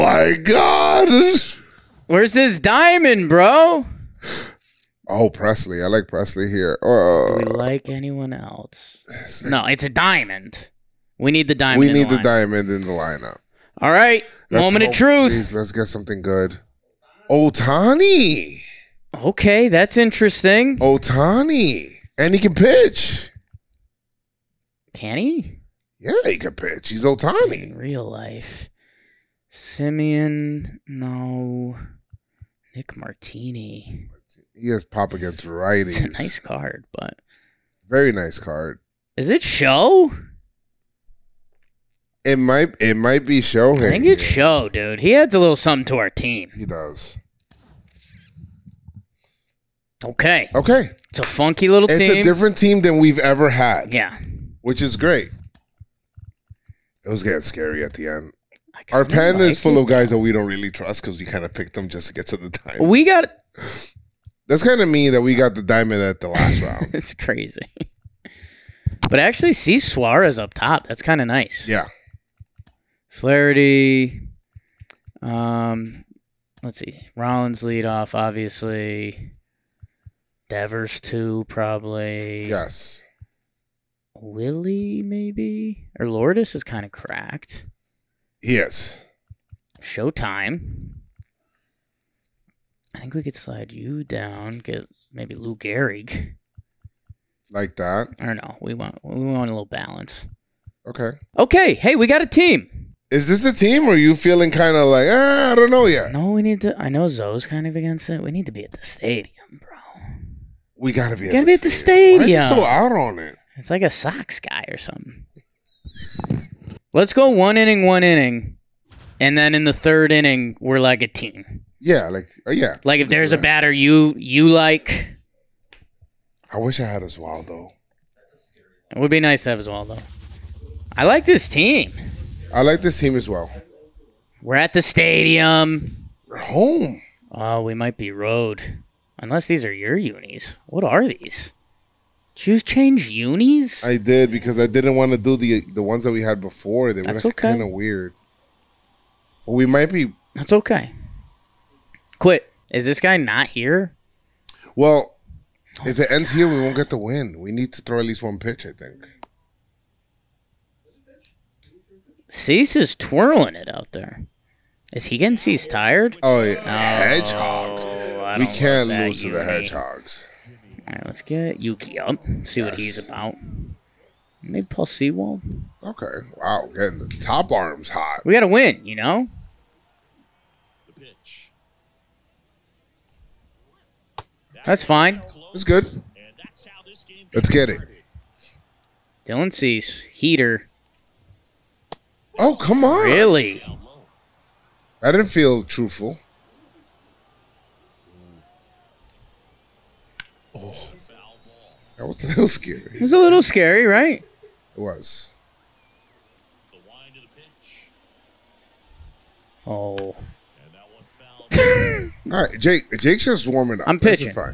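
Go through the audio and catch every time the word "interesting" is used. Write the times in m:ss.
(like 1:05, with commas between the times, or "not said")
0:19.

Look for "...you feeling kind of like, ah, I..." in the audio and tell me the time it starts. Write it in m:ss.
1:43.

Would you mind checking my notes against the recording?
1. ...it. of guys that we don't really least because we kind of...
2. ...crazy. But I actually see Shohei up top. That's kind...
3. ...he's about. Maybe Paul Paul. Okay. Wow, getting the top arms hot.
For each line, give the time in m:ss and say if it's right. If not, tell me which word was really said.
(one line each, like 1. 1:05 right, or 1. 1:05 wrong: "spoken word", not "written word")
1. 0:59 wrong: "trust", not "least"
2. 1:07 wrong: "Suarez", not "Shohei"
3. 2:52 wrong: "Sewald", not "Paul".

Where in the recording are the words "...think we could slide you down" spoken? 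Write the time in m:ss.
1:32.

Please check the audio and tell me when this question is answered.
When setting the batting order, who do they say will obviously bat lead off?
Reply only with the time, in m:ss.
1:17.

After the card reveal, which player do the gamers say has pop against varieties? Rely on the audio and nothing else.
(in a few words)
Nick Martini.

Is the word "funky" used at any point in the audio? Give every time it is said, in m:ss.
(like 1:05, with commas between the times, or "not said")
0:51.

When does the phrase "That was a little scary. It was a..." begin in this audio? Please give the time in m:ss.
3:21.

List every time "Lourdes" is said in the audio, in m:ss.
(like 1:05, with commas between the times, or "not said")
1:26.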